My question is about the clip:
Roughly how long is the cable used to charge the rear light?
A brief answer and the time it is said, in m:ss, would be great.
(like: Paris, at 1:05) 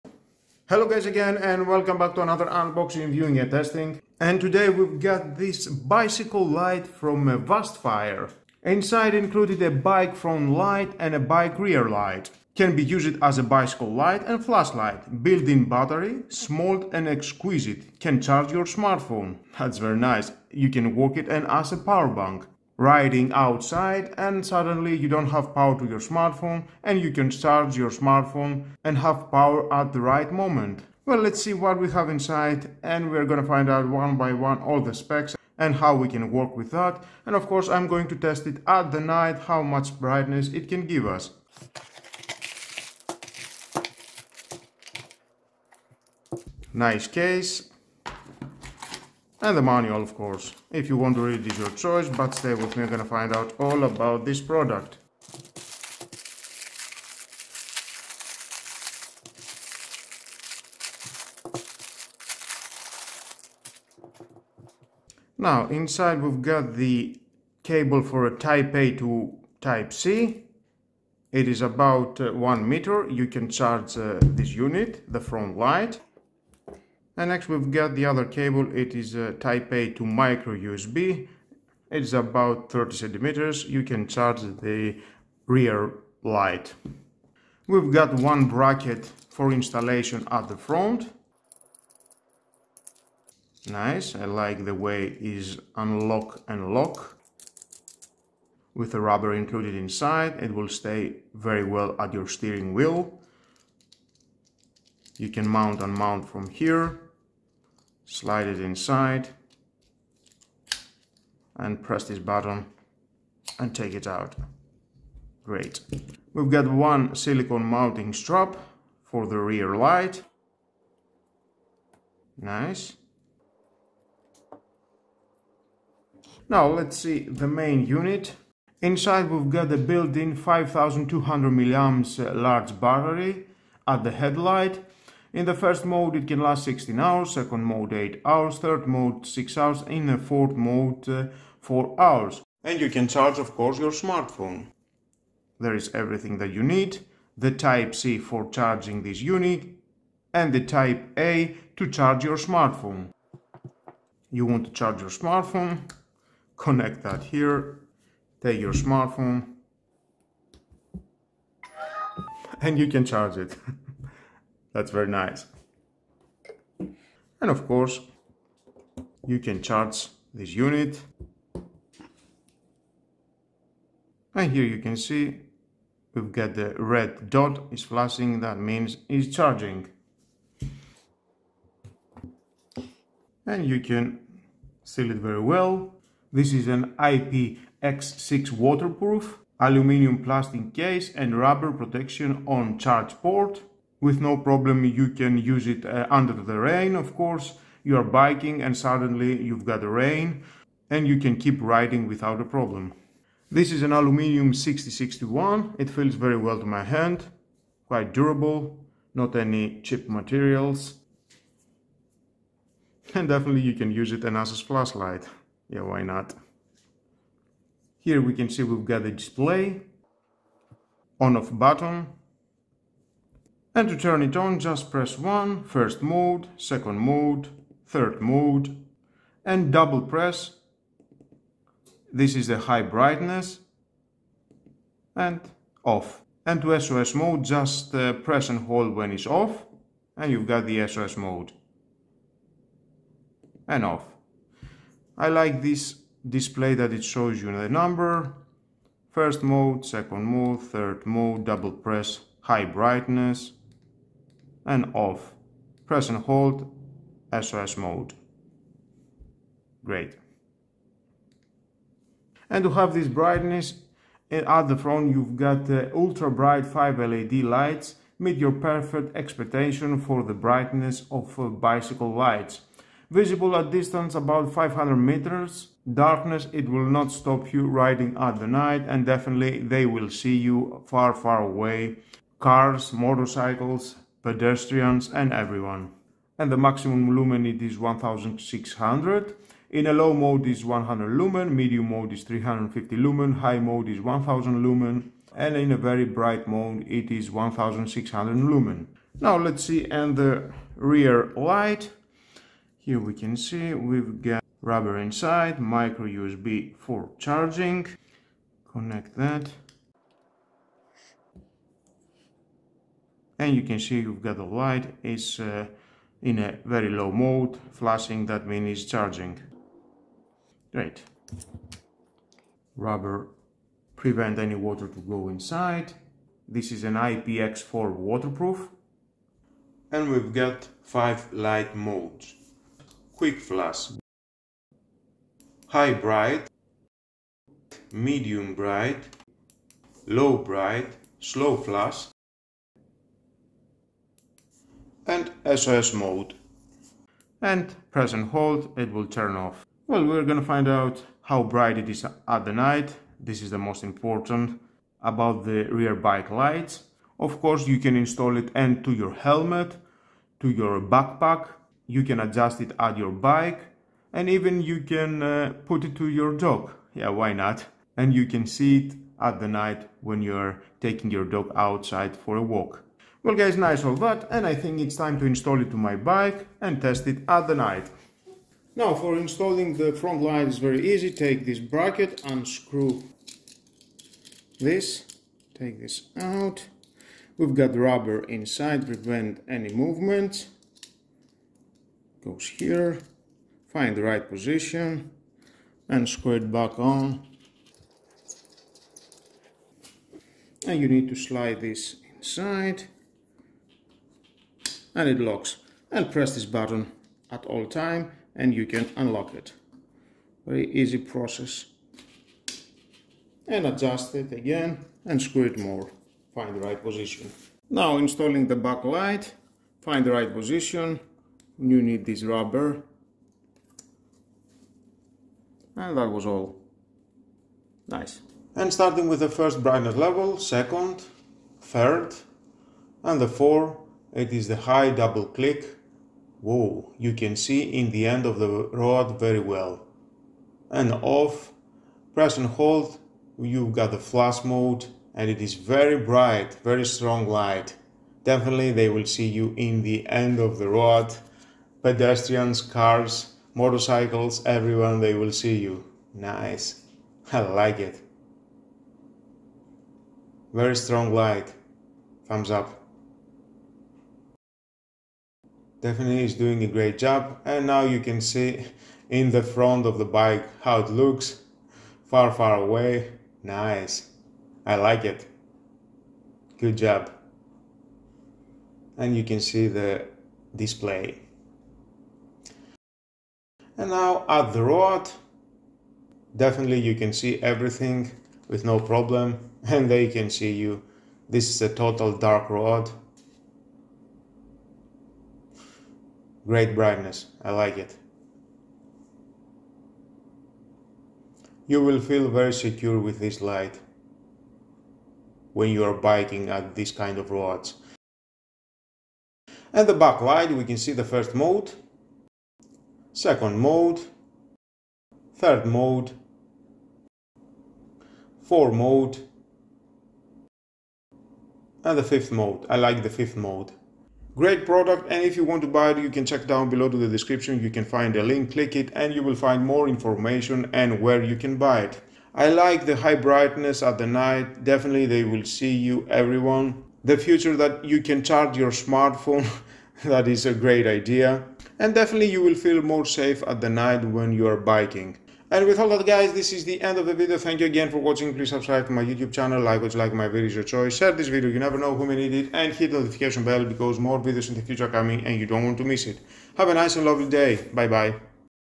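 30 centimeters, at 1:22.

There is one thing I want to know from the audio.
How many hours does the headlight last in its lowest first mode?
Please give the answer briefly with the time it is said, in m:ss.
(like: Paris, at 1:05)
16 hours, at 2:16.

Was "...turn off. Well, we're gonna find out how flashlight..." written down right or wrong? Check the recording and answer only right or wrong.
wrong.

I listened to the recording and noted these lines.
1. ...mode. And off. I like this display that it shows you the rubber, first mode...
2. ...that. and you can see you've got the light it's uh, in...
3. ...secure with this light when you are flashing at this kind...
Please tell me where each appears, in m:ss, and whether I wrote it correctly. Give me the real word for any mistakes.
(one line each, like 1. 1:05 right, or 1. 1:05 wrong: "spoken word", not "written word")
1. 4:01 wrong: "number", not "rubber"
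2. 5:09 right
3. 8:22 wrong: "biking", not "flashing".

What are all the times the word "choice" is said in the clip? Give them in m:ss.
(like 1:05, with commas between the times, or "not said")
0:51, 9:10.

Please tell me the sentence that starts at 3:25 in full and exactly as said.
It feels very well to my hand, quite durable, not any cheap materials.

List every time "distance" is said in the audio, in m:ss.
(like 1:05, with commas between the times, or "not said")
4:33.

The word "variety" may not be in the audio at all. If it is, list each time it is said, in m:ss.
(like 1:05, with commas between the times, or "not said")
not said.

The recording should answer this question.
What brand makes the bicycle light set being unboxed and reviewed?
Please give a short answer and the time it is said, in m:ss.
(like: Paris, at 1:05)
Vastfire, at 0:07.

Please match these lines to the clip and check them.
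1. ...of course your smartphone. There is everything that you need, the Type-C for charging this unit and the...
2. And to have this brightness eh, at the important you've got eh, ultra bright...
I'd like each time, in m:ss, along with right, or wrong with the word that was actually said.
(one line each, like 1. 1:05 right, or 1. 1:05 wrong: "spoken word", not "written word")
1. 2:23 right
2. 4:22 wrong: "front", not "important".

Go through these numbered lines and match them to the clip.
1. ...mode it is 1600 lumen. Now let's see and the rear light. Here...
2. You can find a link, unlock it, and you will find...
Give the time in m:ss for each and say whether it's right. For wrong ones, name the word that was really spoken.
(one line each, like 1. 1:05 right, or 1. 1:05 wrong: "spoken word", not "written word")
1. 4:56 right
2. 8:47 wrong: "click", not "unlock".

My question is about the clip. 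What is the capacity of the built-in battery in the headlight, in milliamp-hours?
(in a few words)
5200.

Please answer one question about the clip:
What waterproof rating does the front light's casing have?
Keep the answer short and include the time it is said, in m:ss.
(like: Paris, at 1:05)
IPX6, at 3:06.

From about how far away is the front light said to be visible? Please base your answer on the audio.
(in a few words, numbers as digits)
500 meters.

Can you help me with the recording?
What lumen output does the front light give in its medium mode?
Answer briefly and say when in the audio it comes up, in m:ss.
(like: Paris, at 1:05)
350 lumen, at 4:52.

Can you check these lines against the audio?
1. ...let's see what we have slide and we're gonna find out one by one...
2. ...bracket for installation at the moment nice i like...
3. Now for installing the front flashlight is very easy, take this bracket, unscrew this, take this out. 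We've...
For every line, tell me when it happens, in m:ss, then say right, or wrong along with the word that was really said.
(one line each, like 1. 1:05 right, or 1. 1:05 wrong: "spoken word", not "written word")
1. 0:31 wrong: "inside", not "slide"
2. 1:28 wrong: "front", not "moment"
3. 6:18 wrong: "light", not "flashlight".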